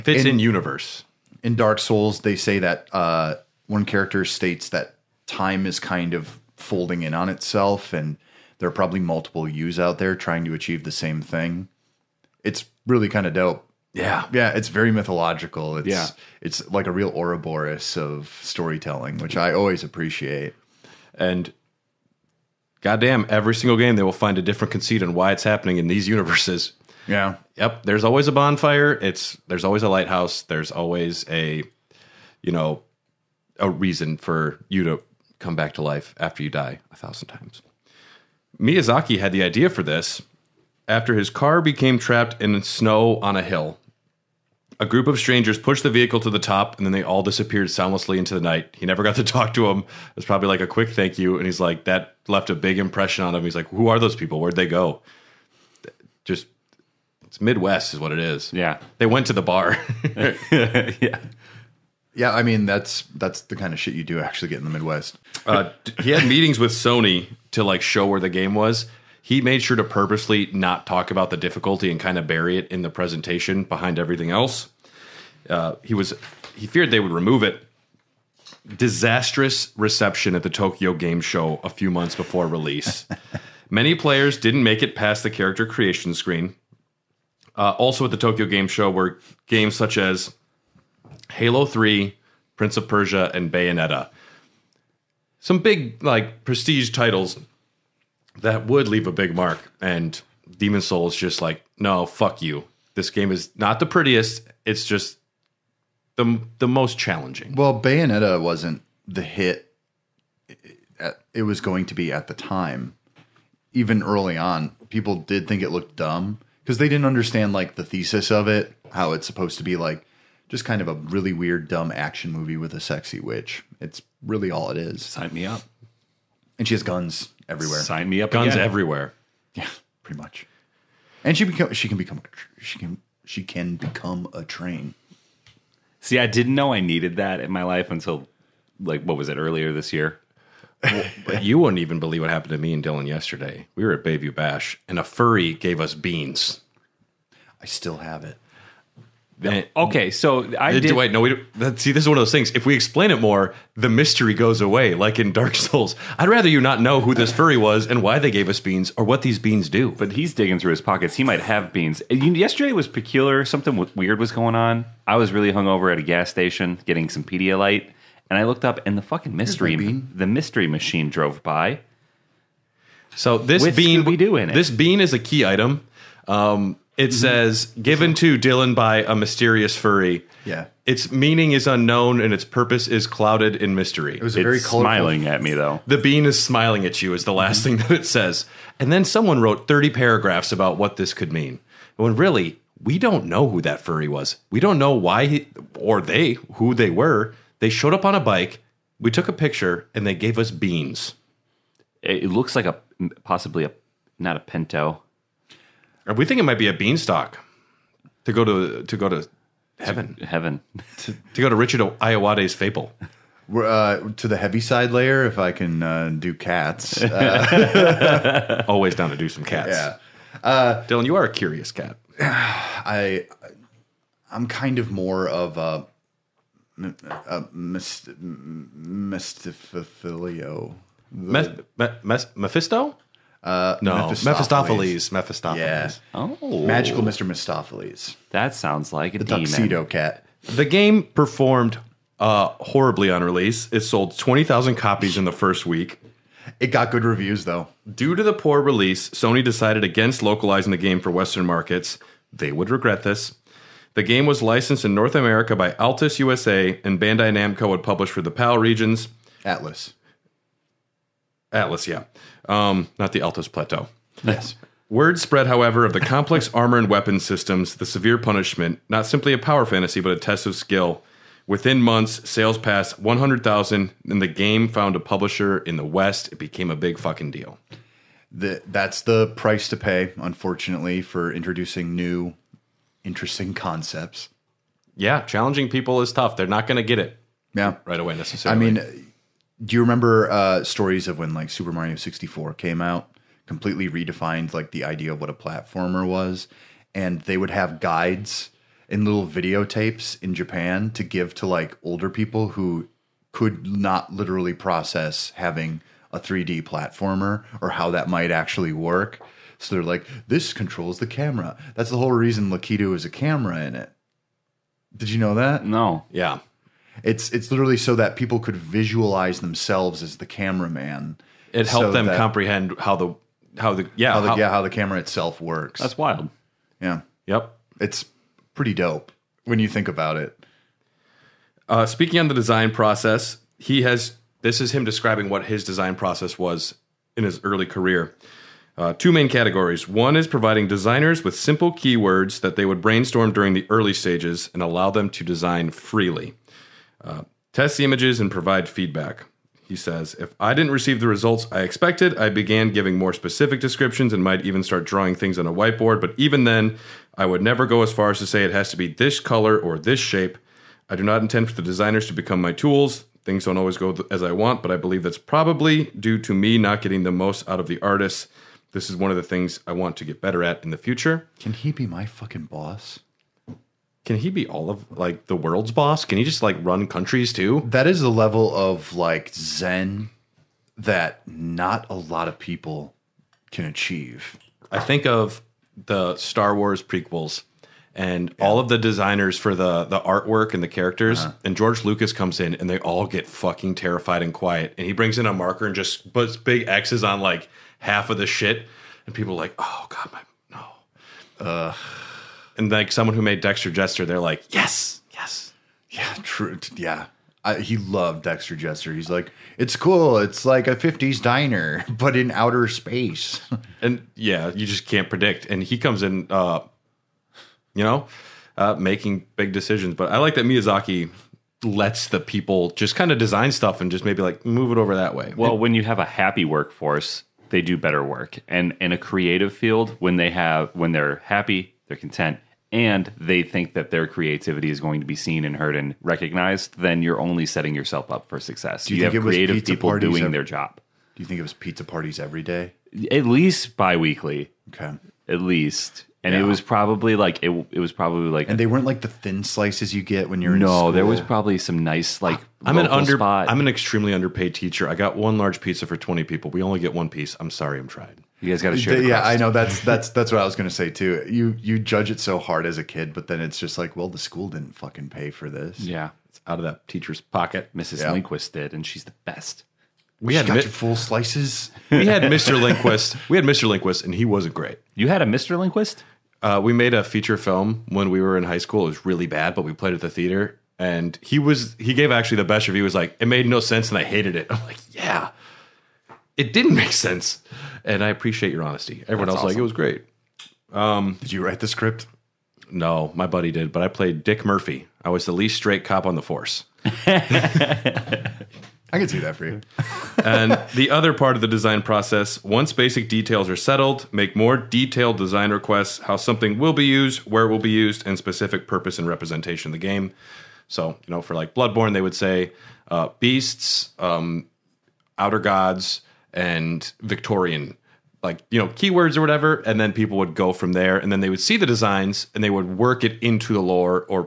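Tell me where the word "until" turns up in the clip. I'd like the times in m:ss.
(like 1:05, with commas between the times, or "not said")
2:17.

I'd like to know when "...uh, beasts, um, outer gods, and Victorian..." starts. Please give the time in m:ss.
8:32.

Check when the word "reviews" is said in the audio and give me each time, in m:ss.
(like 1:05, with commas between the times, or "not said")
4:07, 8:02.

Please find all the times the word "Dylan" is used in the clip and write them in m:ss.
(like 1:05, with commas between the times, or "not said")
2:22, 2:58, 3:40.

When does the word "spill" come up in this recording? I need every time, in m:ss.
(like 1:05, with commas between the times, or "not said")
not said.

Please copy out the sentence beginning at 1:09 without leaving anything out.
He made sure to purposely not talk about the difficulty and kind of bury it in the presentation behind everything else.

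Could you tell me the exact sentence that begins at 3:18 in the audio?
We took a picture and they gave us beans.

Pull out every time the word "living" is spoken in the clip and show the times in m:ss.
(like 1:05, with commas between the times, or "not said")
not said.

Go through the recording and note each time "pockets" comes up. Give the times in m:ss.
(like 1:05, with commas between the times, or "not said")
2:40, 7:47.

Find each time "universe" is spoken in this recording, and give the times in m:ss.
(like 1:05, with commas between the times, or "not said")
0:00, 0:26.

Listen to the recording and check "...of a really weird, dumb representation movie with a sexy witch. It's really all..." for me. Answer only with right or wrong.
wrong.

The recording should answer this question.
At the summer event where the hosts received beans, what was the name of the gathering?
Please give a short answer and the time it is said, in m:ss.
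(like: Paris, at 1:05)
Bayview Bash, at 2:24.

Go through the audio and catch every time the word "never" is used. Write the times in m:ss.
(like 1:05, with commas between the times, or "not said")
0:48, 5:57.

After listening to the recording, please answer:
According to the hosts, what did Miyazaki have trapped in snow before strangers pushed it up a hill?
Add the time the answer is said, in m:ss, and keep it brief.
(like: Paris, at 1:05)
His car, at 0:41.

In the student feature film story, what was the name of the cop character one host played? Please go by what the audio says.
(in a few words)
Dick Murphy.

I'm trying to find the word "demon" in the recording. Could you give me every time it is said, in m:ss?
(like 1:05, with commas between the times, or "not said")
1:40, 3:59.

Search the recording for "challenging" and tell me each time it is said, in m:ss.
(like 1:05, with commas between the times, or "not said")
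1:46, 4:45.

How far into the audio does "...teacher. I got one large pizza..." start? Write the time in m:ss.
7:34.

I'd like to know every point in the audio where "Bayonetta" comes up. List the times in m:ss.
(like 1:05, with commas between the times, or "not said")
1:33, 1:47.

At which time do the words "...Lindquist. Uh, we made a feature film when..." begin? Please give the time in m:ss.
7:55.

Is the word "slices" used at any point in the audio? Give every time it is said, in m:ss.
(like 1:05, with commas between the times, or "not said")
7:29, 7:50.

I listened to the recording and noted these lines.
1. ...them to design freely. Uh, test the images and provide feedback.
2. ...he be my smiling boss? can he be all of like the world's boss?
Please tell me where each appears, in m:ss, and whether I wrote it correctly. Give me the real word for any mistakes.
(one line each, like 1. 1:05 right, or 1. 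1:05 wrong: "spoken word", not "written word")
1. 5:44 right
2. 6:11 wrong: "fucking", not "smiling".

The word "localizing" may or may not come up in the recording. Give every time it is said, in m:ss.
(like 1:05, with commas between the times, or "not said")
4:10.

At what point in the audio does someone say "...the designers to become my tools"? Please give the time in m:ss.
6:01.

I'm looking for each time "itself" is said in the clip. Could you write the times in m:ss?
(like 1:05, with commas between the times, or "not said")
0:07, 5:24.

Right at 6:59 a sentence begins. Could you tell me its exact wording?
But I like that Miyazaki lets the people just kind of design stuff and just maybe like move it over that way.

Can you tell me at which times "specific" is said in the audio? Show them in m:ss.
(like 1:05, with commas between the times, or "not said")
5:53, 8:28.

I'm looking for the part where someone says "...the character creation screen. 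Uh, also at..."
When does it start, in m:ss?
1:25.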